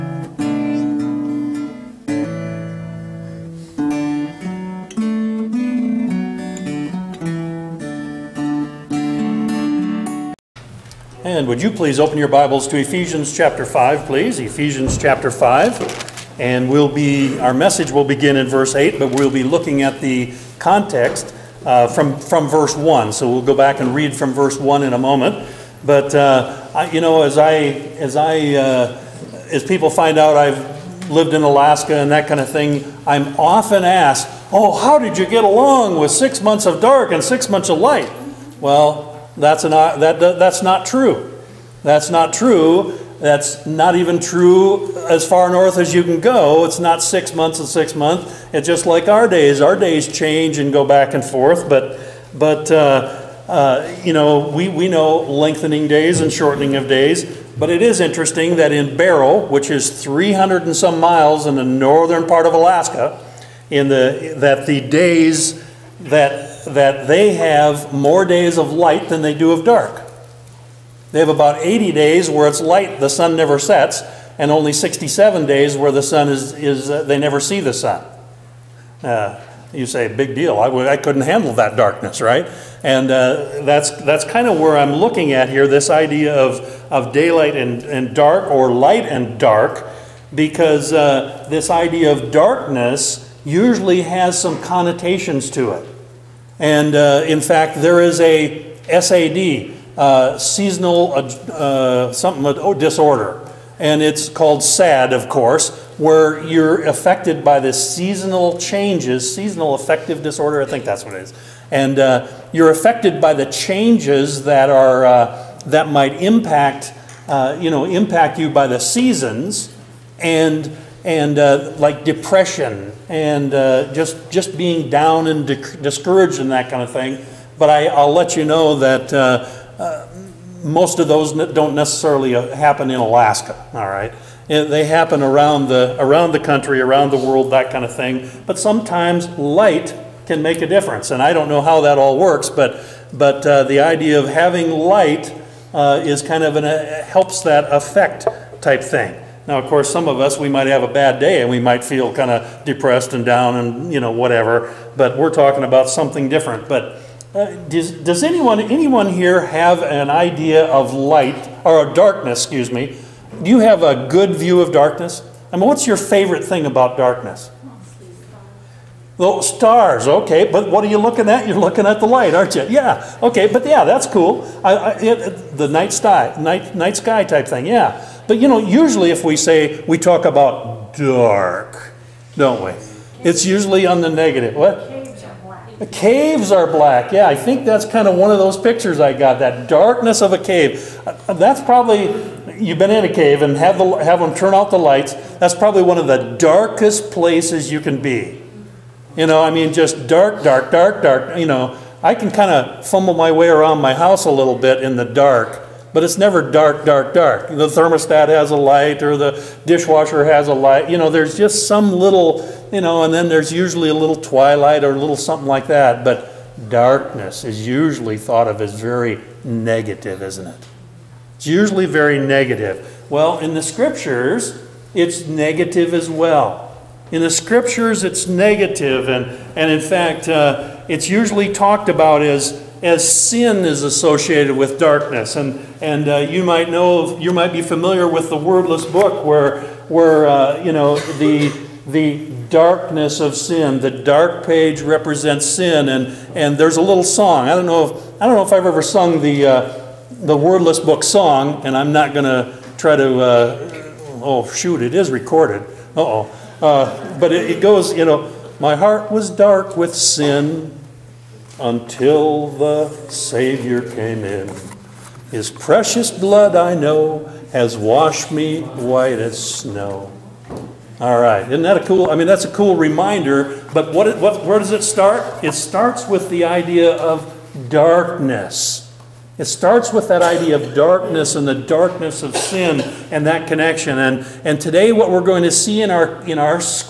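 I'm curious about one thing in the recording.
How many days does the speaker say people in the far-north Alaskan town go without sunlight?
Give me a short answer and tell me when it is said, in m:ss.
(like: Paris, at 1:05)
67, at 1:14.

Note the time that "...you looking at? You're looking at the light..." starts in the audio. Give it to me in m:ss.
2:50.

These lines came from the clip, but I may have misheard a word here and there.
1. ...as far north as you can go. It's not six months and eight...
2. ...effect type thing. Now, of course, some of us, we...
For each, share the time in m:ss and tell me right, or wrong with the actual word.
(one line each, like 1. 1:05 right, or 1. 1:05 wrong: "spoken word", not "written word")
1. 0:45 wrong: "six", not "eight"
2. 2:27 right.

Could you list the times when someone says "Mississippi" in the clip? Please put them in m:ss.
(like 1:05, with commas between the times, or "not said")
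not said.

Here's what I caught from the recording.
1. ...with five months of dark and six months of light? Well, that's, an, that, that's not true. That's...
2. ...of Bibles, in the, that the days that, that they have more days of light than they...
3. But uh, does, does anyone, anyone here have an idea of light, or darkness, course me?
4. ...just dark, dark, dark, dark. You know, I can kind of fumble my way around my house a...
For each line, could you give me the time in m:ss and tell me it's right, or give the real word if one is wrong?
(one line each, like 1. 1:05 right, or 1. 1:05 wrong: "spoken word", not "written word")
1. 0:35 wrong: "six", not "five"
2. 1:02 wrong: "Alaska", not "Bibles"
3. 2:36 wrong: "excuse", not "course"
4. 3:19 right.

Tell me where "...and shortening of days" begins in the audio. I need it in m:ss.
0:56.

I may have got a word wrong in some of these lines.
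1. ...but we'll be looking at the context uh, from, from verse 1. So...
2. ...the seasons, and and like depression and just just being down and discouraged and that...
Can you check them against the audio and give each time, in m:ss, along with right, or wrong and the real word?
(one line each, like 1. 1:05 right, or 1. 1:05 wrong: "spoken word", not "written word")
1. 0:18 right
2. 1:58 right.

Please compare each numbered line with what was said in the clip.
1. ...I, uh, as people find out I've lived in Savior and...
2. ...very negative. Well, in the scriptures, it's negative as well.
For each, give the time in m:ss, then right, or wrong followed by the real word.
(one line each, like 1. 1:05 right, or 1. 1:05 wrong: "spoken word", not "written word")
1. 0:28 wrong: "Alaska", not "Savior"
2. 3:41 right.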